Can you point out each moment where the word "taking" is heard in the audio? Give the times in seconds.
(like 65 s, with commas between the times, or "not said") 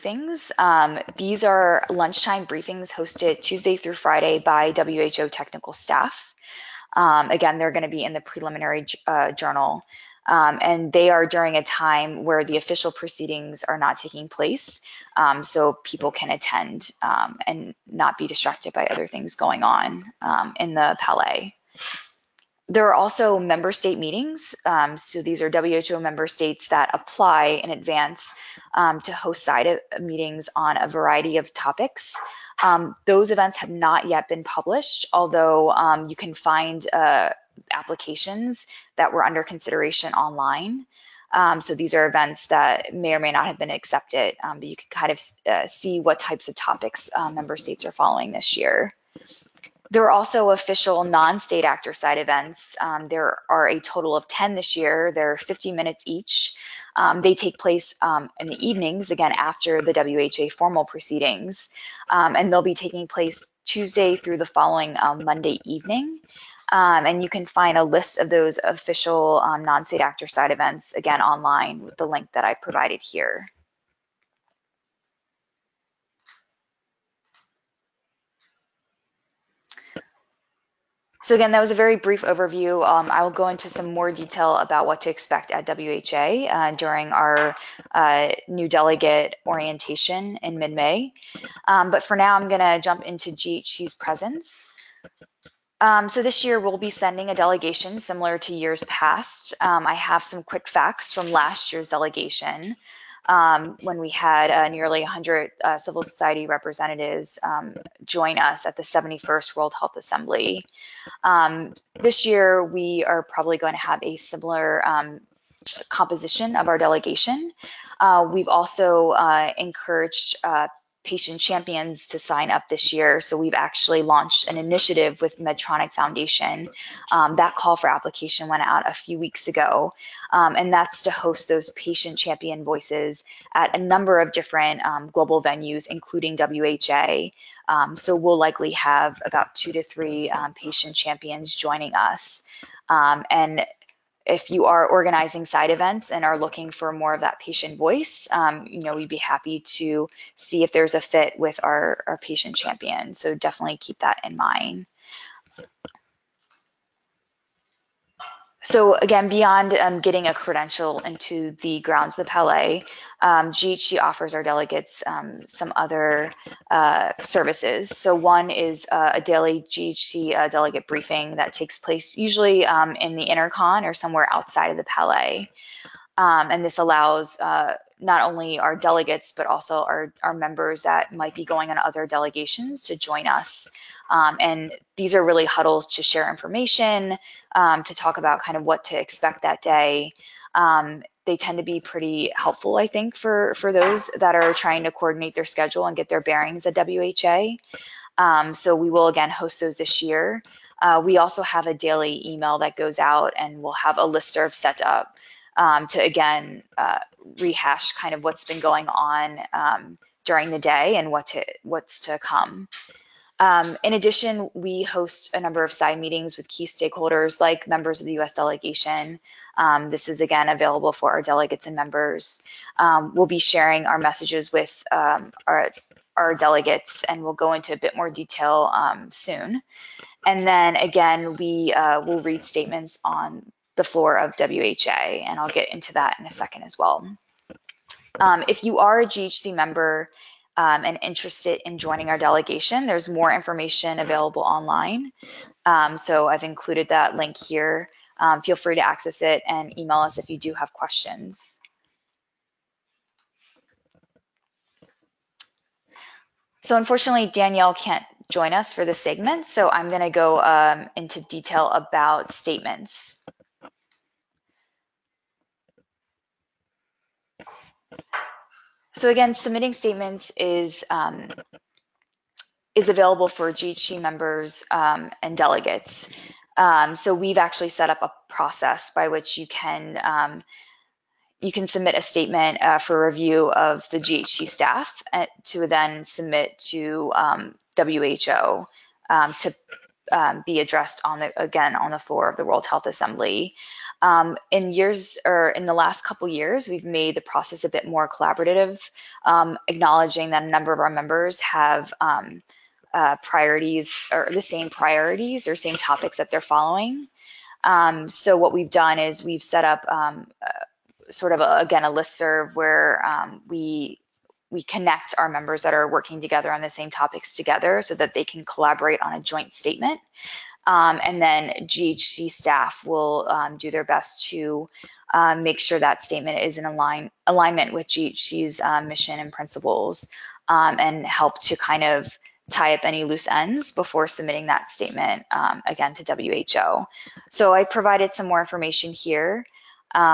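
13 s, 62 s.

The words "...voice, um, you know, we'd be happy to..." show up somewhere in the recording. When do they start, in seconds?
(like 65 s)
147 s.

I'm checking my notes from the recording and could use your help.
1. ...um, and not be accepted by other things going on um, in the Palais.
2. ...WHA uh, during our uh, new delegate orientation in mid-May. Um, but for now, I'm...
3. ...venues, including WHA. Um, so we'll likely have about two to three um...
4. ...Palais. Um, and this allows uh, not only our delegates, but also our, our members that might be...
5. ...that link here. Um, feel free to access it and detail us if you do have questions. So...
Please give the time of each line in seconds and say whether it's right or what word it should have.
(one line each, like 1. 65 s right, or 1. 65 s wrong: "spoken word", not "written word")
1. 17 s wrong: "distracted", not "accepted"
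2. 85 s right
3. 135 s right
4. 174 s right
5. 246 s wrong: "email", not "detail".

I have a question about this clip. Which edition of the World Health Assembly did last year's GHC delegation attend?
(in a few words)
71st.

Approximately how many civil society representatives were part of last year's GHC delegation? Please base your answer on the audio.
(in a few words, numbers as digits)
100.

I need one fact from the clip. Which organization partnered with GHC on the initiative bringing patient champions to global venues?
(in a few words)
Medtronic Foundation.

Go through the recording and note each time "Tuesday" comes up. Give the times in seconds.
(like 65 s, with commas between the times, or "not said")
3 s, 63 s.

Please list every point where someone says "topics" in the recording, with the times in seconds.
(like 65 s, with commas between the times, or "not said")
31 s, 46 s, 305 s, 316 s.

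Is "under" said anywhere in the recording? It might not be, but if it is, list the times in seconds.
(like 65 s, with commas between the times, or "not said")
39 s.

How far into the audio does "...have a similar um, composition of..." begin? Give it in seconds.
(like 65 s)
113 s.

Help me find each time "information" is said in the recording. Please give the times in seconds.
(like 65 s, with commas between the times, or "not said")
186 s, 243 s, 338 s.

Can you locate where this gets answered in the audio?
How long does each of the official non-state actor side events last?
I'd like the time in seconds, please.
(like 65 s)
55 s.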